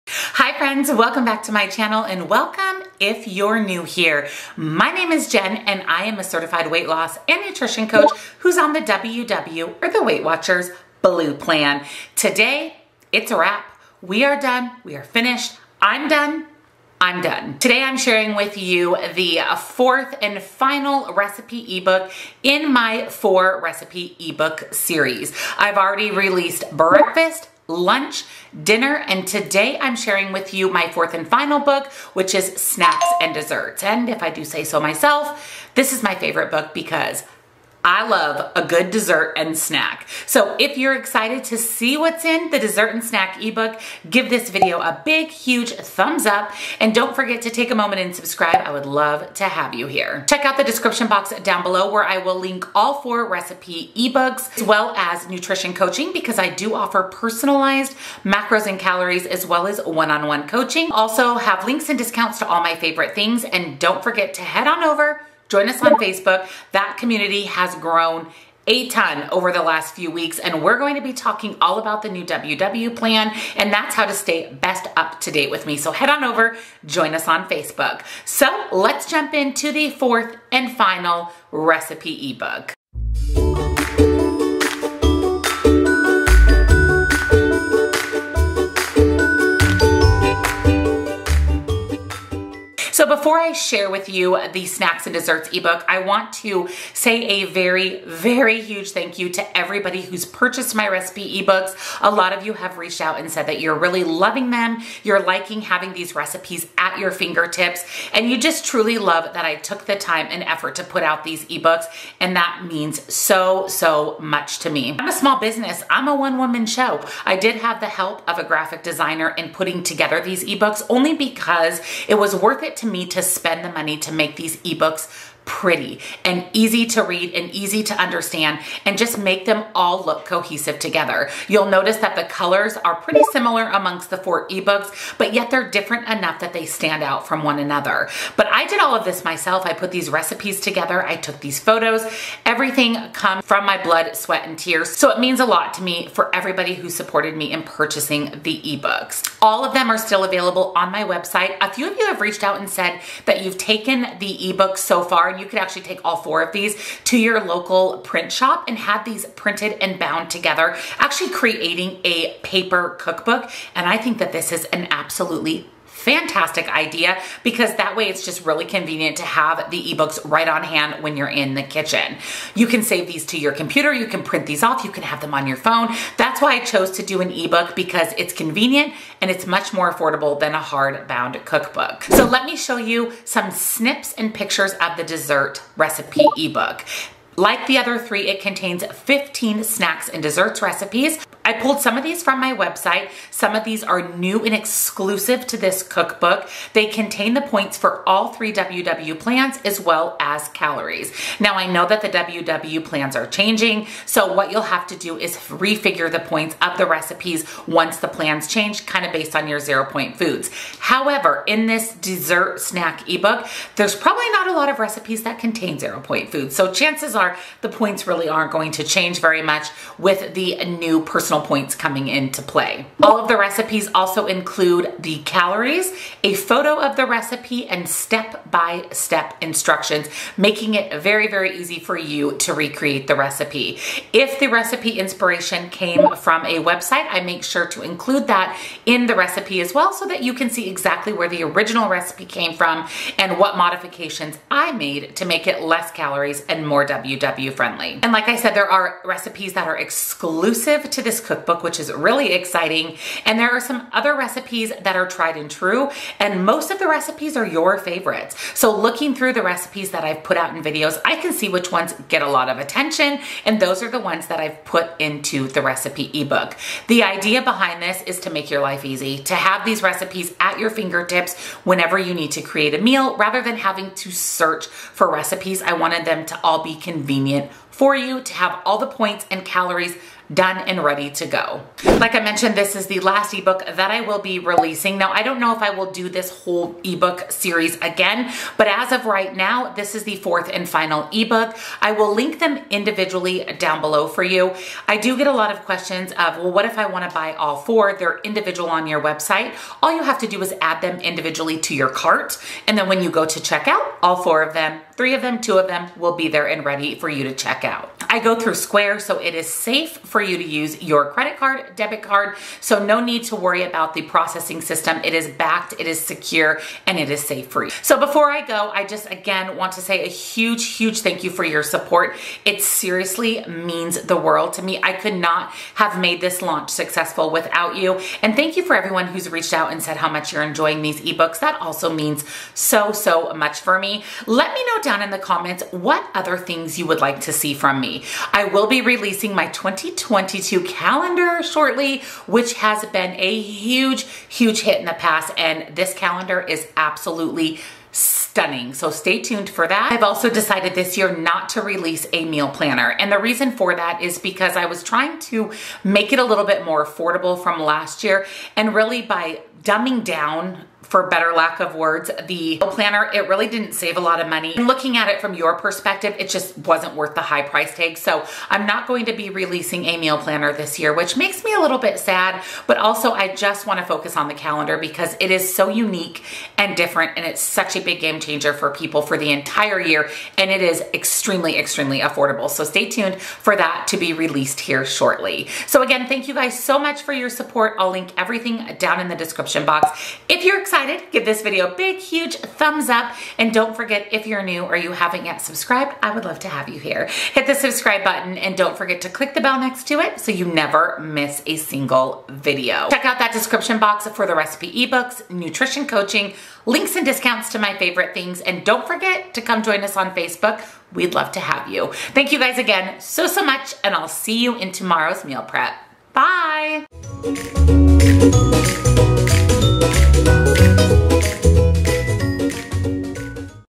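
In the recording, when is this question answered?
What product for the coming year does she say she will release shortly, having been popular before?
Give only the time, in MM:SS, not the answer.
05:39.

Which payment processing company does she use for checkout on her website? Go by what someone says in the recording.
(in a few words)
Square.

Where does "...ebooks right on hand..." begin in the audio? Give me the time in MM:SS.
02:49.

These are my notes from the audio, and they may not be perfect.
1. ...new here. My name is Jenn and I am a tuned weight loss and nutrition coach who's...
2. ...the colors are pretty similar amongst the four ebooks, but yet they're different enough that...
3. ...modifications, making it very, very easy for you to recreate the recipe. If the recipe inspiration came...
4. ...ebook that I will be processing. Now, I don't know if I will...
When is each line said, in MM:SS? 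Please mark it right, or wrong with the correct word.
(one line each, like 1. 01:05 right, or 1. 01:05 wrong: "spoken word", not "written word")
1. 00:03 wrong: "certified", not "tuned"
2. 02:12 right
3. 03:49 wrong: "instructions", not "modifications"
4. 04:43 wrong: "releasing", not "processing".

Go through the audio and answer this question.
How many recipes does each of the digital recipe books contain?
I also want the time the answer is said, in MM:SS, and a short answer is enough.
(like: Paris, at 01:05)
15, at 03:08.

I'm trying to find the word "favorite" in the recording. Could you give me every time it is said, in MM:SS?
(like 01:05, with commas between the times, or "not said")
00:36, 01:02, 04:17, 06:47.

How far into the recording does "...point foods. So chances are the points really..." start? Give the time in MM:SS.
03:36.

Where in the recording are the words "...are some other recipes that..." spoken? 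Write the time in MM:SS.
04:13.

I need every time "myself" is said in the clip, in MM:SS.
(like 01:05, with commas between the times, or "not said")
00:34, 02:19.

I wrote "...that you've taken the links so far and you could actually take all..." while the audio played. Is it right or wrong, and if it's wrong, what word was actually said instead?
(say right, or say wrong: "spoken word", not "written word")
wrong: "ebooks", not "links".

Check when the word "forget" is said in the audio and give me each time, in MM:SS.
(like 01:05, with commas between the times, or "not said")
00:47, 01:04, 06:33, 06:38, 06:48.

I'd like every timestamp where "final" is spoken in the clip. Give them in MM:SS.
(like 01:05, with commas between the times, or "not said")
00:20, 00:31, 01:20, 04:50.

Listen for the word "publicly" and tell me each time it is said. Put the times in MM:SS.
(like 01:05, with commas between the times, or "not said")
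not said.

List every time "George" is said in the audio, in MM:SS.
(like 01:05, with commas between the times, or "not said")
not said.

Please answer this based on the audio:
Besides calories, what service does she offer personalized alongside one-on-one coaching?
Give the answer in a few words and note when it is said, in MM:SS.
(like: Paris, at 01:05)
macros, at 00:58.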